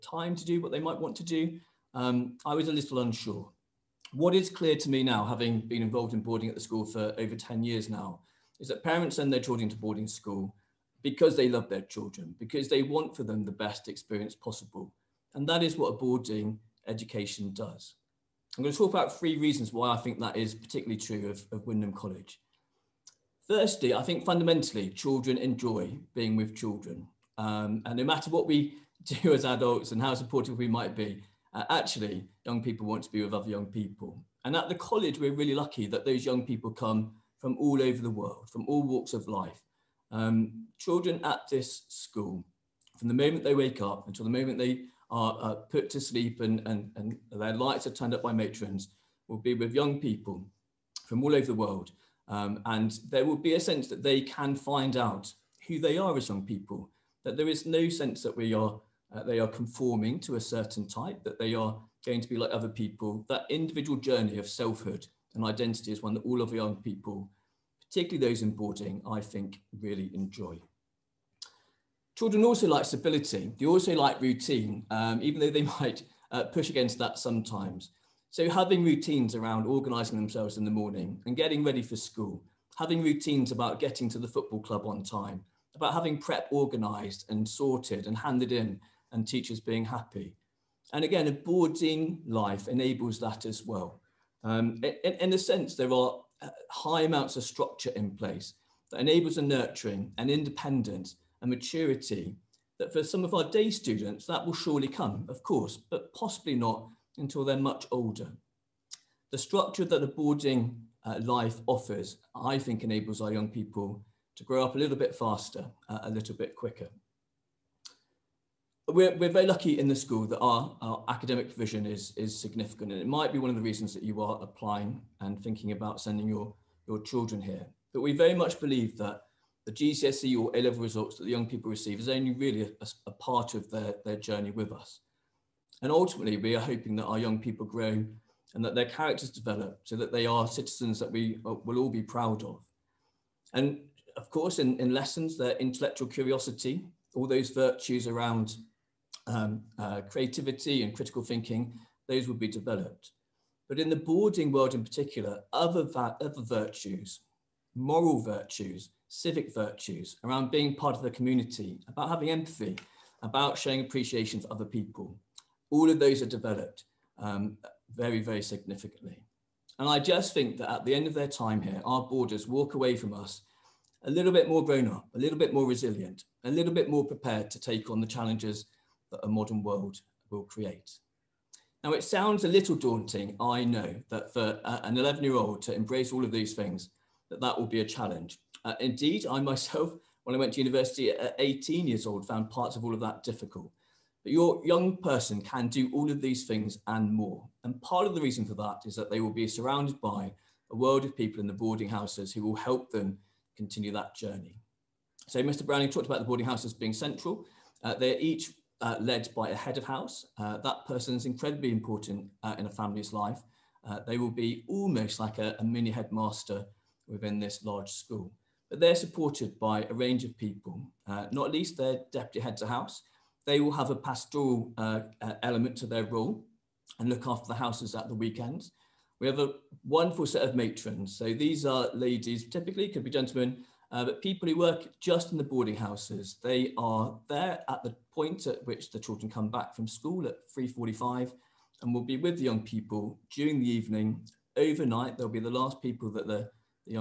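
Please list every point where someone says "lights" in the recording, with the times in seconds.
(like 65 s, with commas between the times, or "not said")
47 s.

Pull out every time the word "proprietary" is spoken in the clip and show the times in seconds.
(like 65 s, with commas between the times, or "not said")
not said.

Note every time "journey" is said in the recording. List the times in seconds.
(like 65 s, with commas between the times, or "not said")
63 s, 134 s, 204 s.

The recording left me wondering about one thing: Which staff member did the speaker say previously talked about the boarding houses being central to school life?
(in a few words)
Mr. Browning.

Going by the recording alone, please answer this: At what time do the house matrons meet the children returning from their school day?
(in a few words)
3.45.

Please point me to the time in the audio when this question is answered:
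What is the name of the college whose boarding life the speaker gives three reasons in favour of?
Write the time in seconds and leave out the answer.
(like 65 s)
21 s.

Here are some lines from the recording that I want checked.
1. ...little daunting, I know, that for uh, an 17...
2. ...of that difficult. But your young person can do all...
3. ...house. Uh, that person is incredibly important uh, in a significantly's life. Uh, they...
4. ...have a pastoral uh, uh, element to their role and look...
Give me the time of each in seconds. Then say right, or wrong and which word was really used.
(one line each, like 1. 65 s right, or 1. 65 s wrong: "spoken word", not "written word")
1. 182 s wrong: "11", not "17"
2. 192 s right
3. 209 s wrong: "family", not "significantly"
4. 223 s right.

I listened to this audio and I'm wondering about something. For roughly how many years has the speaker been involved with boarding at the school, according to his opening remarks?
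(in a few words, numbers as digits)
over 10 years.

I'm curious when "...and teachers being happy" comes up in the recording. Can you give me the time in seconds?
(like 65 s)
89 s.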